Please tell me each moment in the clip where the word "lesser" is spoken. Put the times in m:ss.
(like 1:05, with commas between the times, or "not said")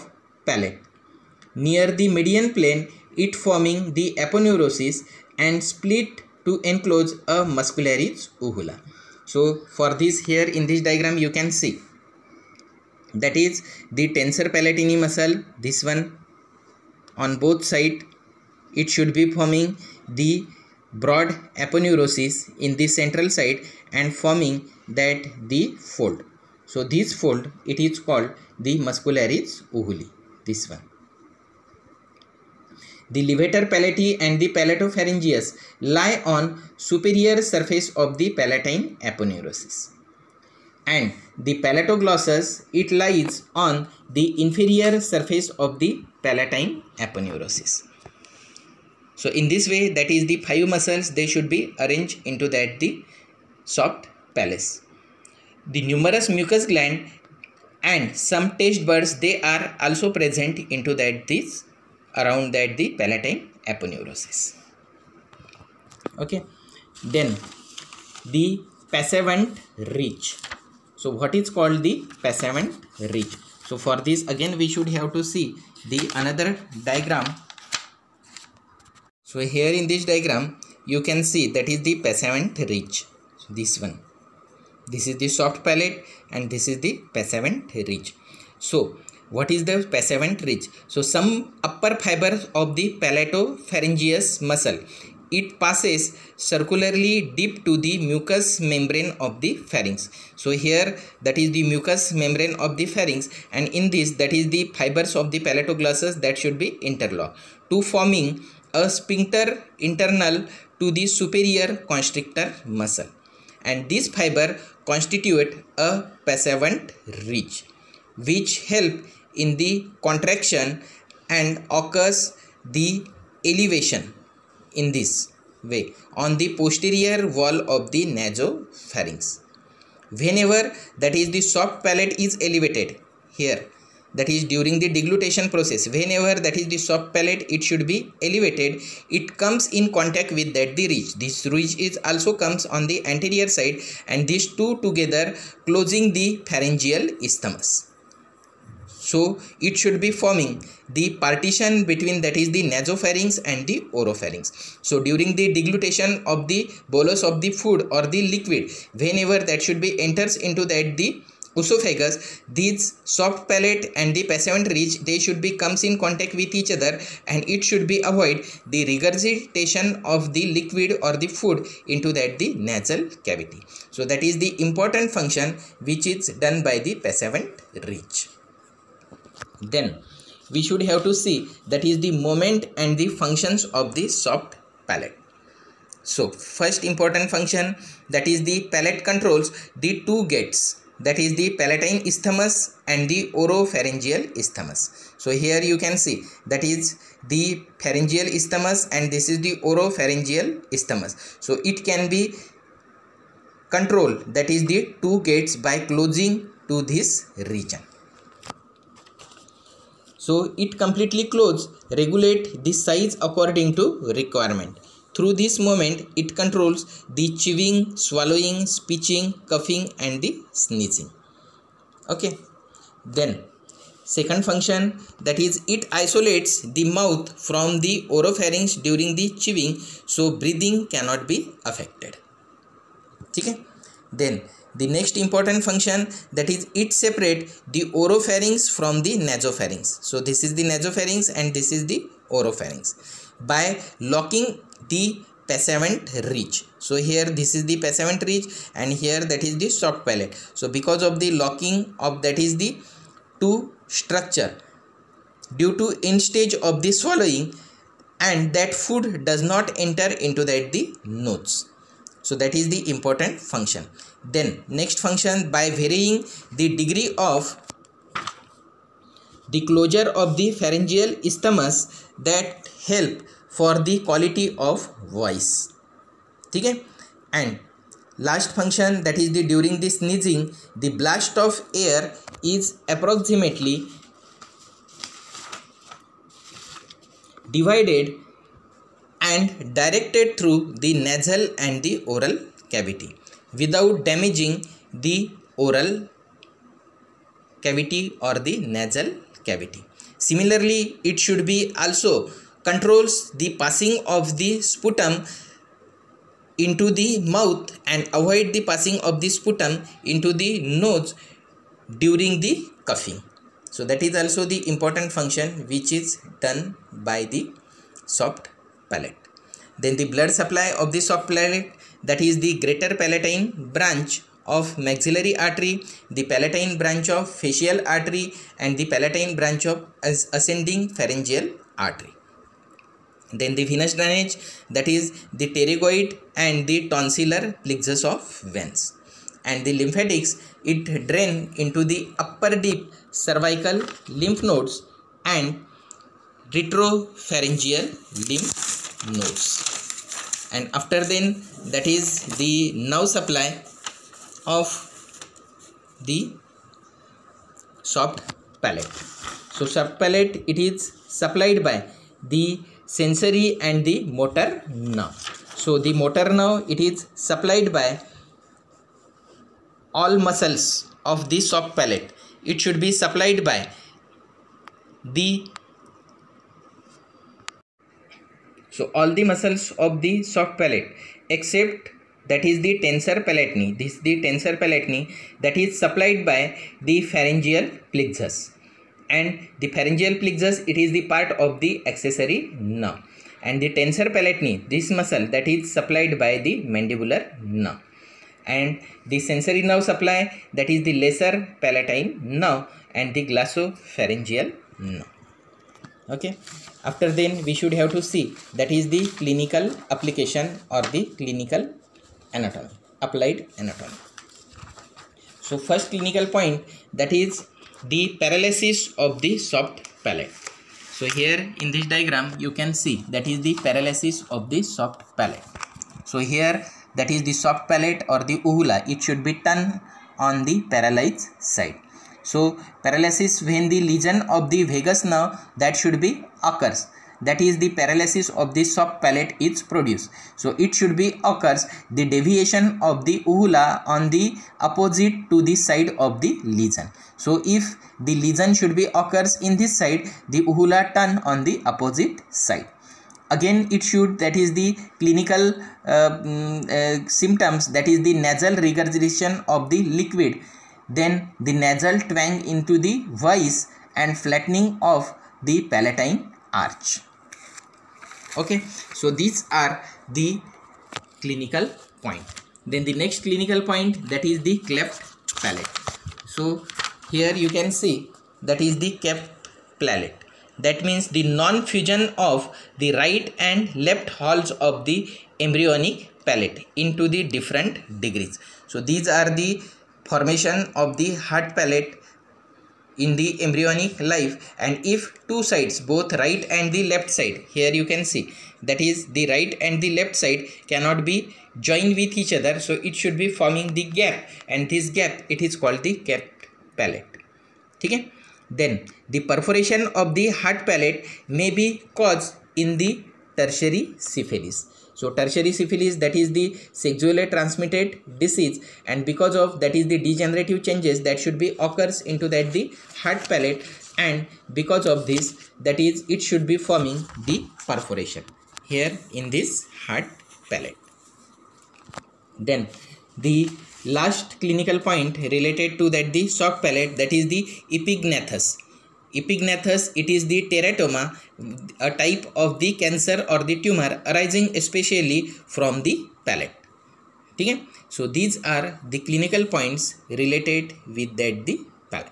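6:41.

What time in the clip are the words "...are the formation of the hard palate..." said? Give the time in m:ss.
8:09.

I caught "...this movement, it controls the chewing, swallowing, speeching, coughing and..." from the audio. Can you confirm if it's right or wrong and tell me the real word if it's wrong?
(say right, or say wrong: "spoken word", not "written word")
right.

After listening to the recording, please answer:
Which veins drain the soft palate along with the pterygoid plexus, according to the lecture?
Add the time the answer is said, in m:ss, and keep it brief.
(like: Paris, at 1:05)
tonsillar plexus, at 5:36.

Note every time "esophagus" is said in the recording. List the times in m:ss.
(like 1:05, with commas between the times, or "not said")
2:41.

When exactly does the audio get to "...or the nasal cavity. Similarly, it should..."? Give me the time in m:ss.
4:58.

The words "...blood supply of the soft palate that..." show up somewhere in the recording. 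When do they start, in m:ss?
5:20.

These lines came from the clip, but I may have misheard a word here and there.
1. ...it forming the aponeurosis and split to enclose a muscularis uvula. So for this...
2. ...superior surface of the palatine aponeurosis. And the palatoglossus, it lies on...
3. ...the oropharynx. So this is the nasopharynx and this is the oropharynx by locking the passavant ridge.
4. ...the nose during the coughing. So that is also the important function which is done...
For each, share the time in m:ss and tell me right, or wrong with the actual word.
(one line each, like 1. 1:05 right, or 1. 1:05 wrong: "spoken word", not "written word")
1. 0:03 right
2. 0:36 right
3. 3:59 wrong: "nasopharynx", not "oropharynx"
4. 5:10 right.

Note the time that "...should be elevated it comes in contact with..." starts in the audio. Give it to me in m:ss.
2:17.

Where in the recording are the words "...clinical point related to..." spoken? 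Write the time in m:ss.
8:54.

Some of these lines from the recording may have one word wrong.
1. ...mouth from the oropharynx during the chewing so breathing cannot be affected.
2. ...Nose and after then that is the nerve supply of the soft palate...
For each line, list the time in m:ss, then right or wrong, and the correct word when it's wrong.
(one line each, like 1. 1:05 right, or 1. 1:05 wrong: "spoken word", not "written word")
1. 3:46 right
2. 5:49 right.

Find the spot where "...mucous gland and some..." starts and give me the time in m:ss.
0:56.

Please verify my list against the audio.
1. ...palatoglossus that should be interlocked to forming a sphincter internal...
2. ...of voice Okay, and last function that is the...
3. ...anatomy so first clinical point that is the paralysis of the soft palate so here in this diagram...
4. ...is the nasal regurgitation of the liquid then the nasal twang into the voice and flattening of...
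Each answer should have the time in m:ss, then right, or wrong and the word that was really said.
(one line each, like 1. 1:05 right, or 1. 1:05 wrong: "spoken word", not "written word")
1. 1:45 right
2. 4:34 right
3. 6:53 right
4. 7:37 right.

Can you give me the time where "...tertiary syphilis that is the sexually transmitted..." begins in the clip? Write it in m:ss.
8:35.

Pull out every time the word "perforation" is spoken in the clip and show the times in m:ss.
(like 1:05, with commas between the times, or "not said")
8:29, 8:47.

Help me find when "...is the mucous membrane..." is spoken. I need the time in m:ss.
1:41.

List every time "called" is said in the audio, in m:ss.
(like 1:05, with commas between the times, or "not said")
0:27, 1:11, 8:25.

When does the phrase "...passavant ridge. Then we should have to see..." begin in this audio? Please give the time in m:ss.
2:56.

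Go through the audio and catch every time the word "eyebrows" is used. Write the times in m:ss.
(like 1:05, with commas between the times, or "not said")
not said.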